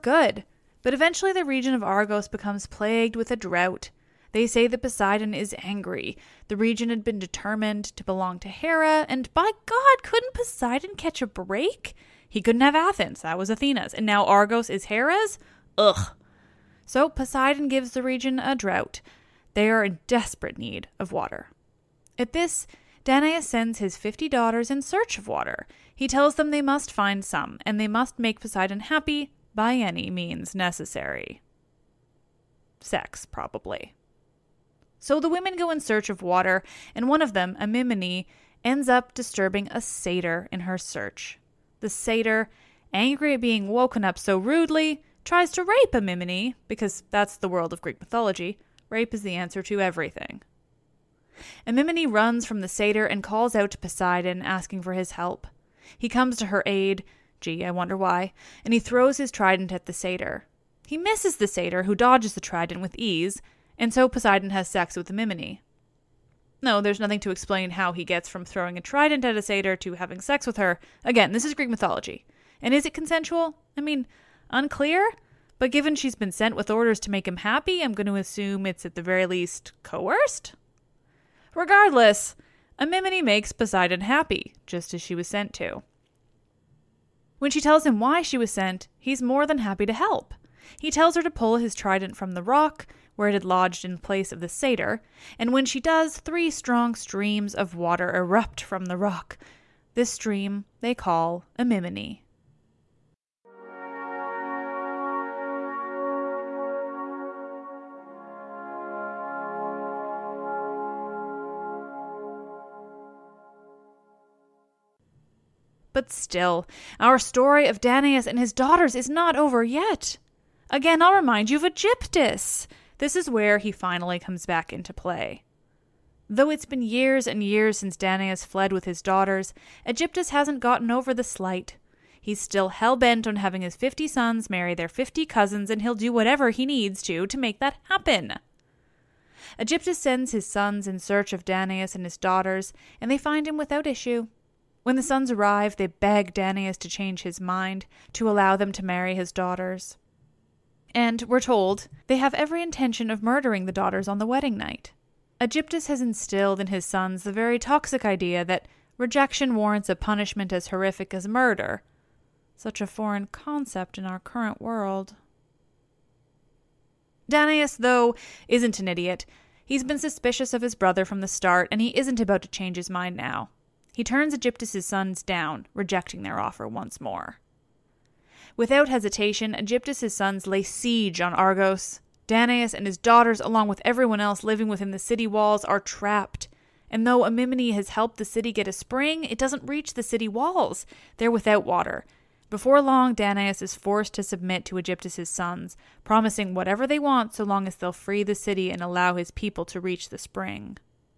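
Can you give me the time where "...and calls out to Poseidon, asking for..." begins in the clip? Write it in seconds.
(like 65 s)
53 s.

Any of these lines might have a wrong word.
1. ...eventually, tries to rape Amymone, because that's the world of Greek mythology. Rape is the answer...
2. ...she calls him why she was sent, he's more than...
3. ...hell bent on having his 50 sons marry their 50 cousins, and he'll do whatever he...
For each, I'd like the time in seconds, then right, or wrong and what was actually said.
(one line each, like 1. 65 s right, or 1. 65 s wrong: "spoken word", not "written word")
1. 44 s wrong: "rudely", not "eventually"
2. 87 s wrong: "tells", not "calls"
3. 132 s right.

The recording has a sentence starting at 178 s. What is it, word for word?
Without hesitation, Aegyptus' sons lay siege on Argos.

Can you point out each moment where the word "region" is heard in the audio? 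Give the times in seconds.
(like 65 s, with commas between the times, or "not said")
1 s, 6 s, 18 s.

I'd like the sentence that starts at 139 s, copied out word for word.
Aegyptus sends his sons in search of Danaus and his daughters, and they find him without issue.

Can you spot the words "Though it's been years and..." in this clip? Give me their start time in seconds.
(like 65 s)
126 s.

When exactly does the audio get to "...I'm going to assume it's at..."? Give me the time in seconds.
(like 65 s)
77 s.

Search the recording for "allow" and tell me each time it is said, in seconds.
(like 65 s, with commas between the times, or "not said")
148 s, 198 s.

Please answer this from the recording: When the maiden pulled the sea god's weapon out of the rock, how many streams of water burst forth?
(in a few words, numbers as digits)
3.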